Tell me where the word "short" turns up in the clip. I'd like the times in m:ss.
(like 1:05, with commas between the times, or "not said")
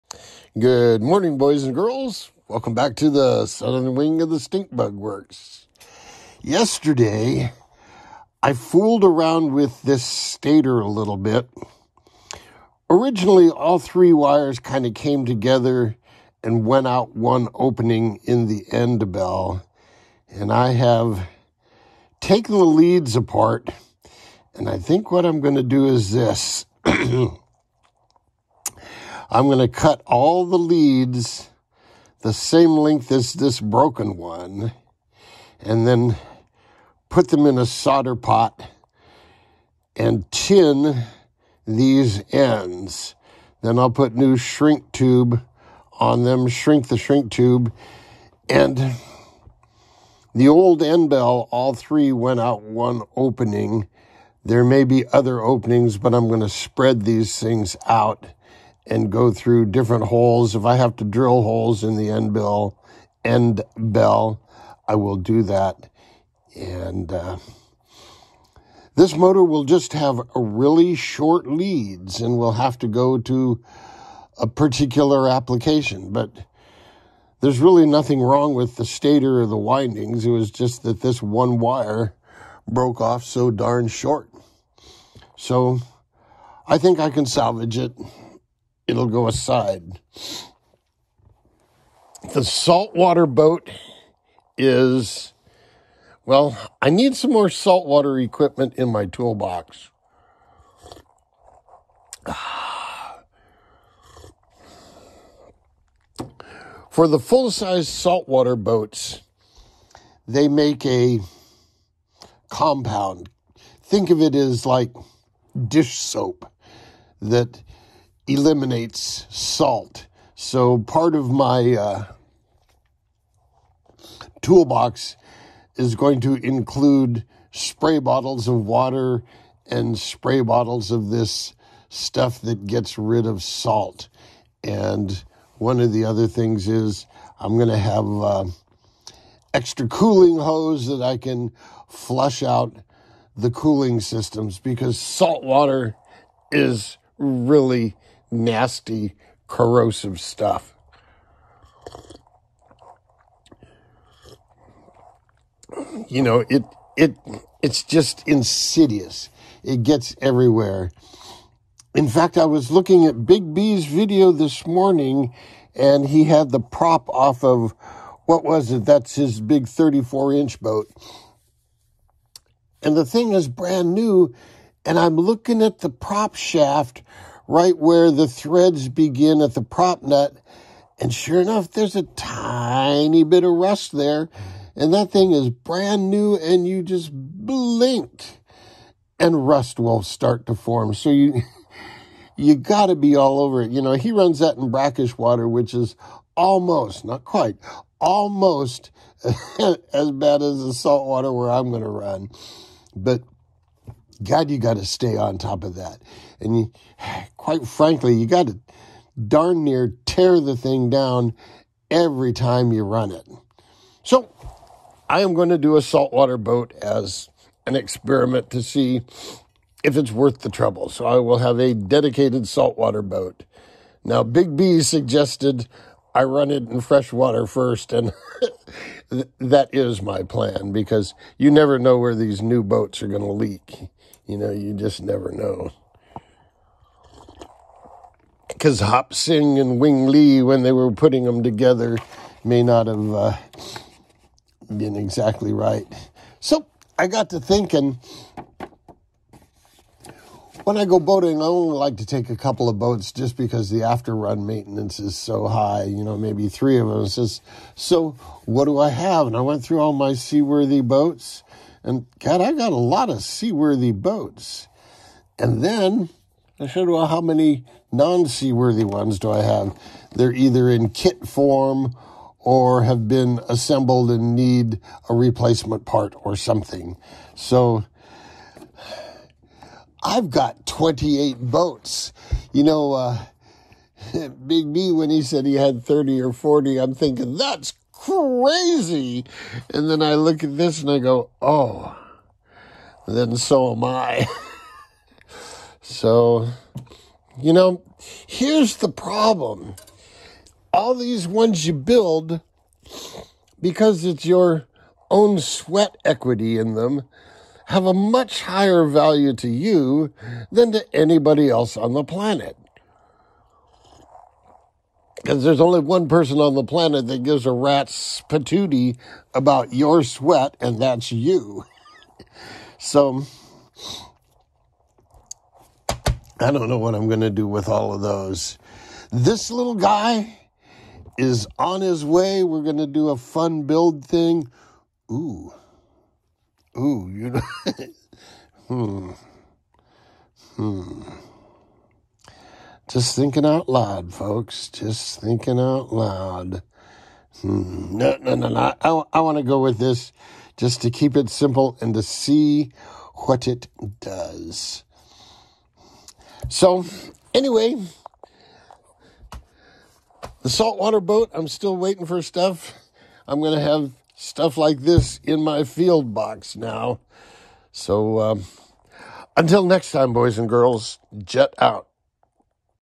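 1:10, 1:23.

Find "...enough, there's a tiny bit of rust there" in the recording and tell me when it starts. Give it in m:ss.
3:01.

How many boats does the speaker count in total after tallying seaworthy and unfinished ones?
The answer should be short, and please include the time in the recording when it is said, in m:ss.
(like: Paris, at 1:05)
28, at 4:40.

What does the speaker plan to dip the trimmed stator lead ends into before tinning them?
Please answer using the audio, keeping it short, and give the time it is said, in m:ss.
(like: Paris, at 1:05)
Solder pot, at 0:37.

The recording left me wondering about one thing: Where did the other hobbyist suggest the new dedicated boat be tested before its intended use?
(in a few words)
Fresh water.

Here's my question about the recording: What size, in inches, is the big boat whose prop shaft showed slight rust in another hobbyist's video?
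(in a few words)
34 inch.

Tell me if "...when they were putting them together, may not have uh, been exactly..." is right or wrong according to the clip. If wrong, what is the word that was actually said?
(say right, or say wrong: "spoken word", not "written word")
right.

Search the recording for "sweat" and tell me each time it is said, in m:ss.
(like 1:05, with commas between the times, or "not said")
5:05, 5:20.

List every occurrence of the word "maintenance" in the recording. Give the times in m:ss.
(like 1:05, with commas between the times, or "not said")
4:14.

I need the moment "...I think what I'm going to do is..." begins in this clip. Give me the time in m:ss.
0:24.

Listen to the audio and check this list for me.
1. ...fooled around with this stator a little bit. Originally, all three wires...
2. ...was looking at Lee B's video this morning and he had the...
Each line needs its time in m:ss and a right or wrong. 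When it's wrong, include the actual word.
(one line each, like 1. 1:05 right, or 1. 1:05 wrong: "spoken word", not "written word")
1. 0:08 right
2. 2:42 wrong: "Big", not "Lee".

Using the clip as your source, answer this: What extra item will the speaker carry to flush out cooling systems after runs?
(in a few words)
Extra cooling hose.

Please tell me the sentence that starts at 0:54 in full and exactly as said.
There may be other openings, but I'm going to spread these things out and go through different holes.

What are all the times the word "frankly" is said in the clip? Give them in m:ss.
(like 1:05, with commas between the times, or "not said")
3:27.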